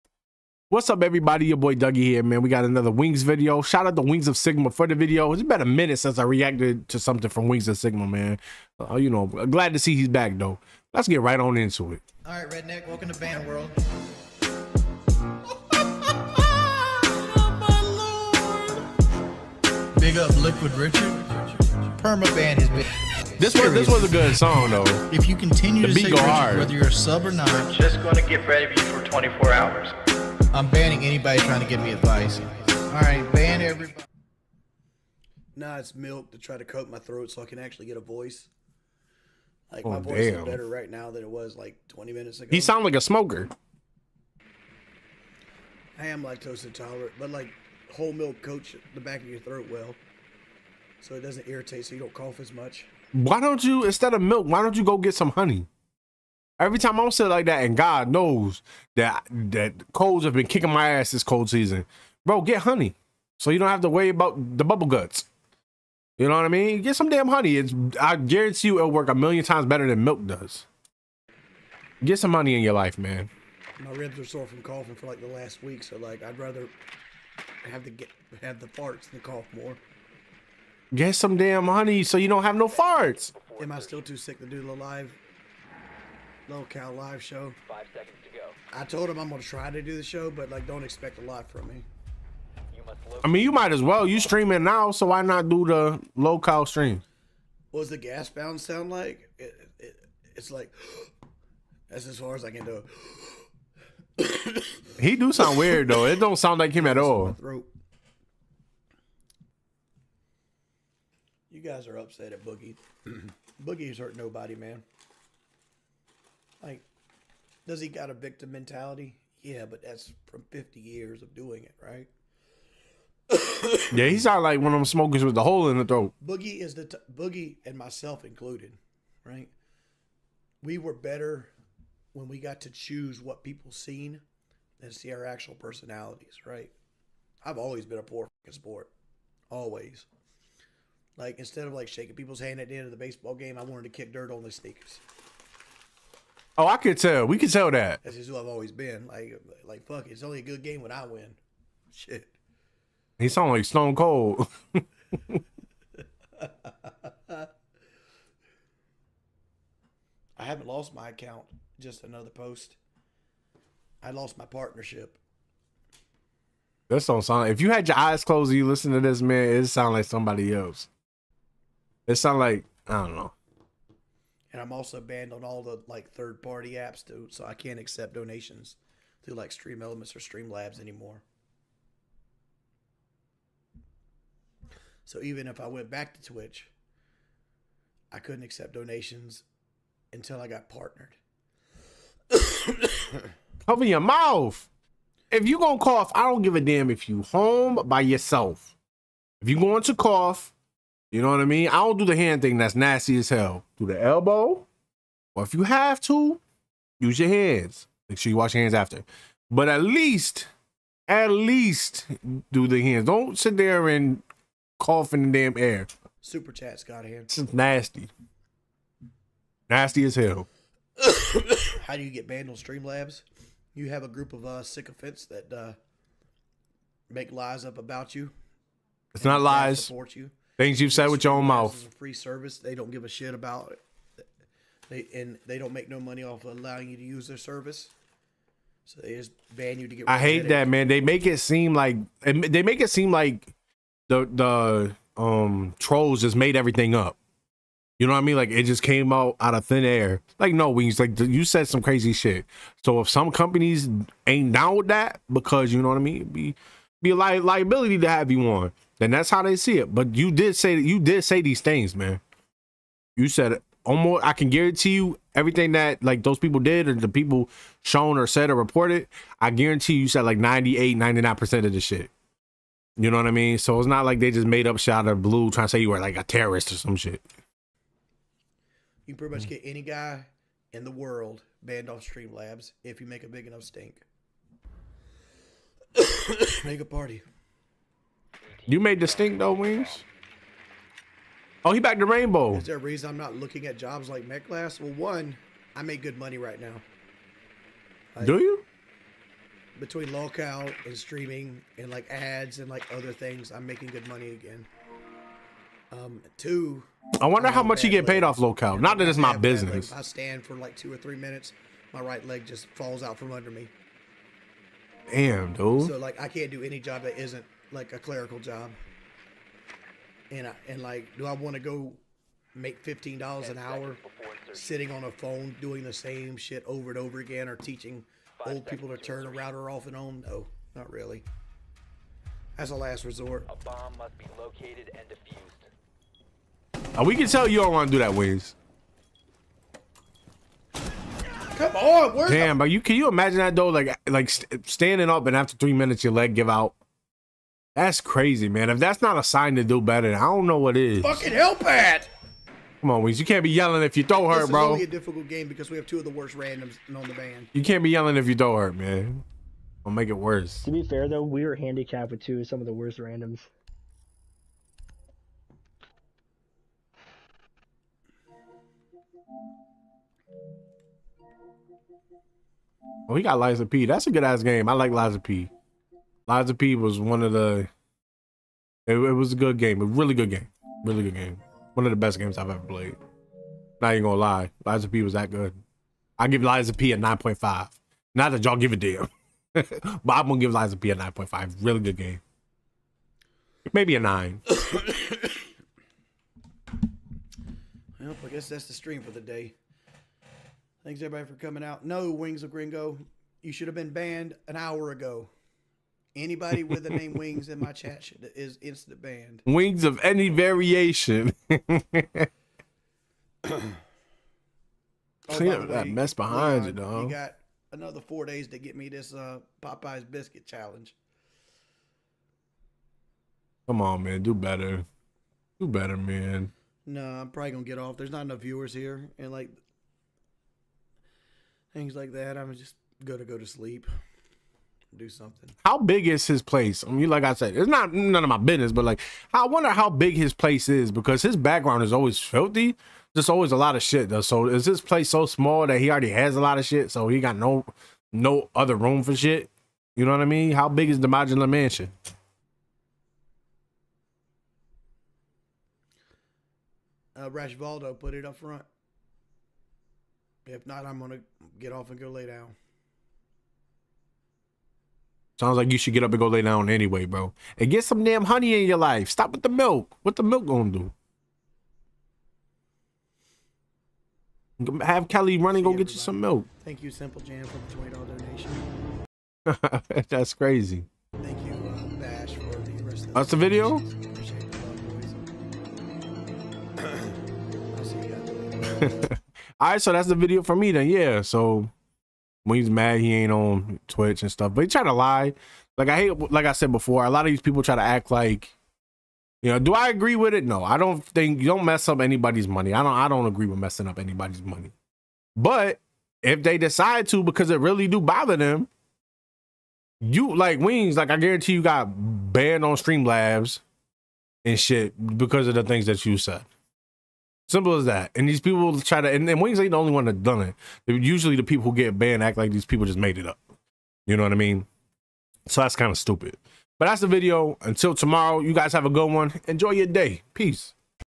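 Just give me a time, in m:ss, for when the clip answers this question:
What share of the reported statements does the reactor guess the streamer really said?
4:30.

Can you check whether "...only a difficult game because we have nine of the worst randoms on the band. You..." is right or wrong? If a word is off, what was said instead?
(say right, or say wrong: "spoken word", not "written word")
wrong: "two", not "nine".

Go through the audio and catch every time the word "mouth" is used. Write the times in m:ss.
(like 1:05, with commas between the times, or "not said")
3:13, 3:51.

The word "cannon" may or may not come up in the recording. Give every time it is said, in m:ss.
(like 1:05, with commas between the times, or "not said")
not said.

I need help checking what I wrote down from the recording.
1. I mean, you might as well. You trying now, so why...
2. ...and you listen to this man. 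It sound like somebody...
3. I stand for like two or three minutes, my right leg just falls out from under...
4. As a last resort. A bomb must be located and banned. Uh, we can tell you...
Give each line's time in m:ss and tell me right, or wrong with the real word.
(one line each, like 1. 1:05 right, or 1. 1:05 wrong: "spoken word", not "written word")
1. 1:33 wrong: "streaming", not "trying"
2. 2:48 right
3. 5:09 right
4. 5:32 wrong: "defused", not "banned".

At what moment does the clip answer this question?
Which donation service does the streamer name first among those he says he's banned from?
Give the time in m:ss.
2:59.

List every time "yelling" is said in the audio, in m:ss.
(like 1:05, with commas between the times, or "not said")
5:53, 5:57.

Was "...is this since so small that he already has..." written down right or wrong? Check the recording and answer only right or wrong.
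wrong.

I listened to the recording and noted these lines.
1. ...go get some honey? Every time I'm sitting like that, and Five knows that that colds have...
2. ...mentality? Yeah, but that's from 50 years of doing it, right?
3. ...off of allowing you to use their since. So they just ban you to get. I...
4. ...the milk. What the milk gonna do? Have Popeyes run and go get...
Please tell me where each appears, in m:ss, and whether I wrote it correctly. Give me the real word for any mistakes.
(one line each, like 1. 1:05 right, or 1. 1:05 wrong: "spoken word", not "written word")
1. 0:54 wrong: "God", not "Five"
2. 1:58 right
3. 3:56 wrong: "service", not "since"
4. 7:49 wrong: "Kelly", not "Popeyes".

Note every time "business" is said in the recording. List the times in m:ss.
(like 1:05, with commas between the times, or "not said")
5:09, 7:18.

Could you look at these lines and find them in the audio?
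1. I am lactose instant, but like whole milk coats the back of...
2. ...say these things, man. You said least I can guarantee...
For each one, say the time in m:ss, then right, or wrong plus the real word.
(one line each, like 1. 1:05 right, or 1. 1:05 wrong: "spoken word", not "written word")
1. 0:45 wrong: "intolerant", not "instant"
2. 4:21 wrong: "almost", not "least".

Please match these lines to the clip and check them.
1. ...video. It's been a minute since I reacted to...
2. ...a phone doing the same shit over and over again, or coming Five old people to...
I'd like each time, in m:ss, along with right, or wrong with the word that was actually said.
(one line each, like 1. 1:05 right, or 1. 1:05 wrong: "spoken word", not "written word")
1. 0:04 right
2. 5:25 wrong: "teaching", not "coming".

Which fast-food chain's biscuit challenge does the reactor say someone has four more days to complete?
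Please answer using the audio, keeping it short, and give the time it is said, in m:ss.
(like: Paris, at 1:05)
Popeyes, at 6:59.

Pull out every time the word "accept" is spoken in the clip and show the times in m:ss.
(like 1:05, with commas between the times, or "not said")
2:57, 3:08.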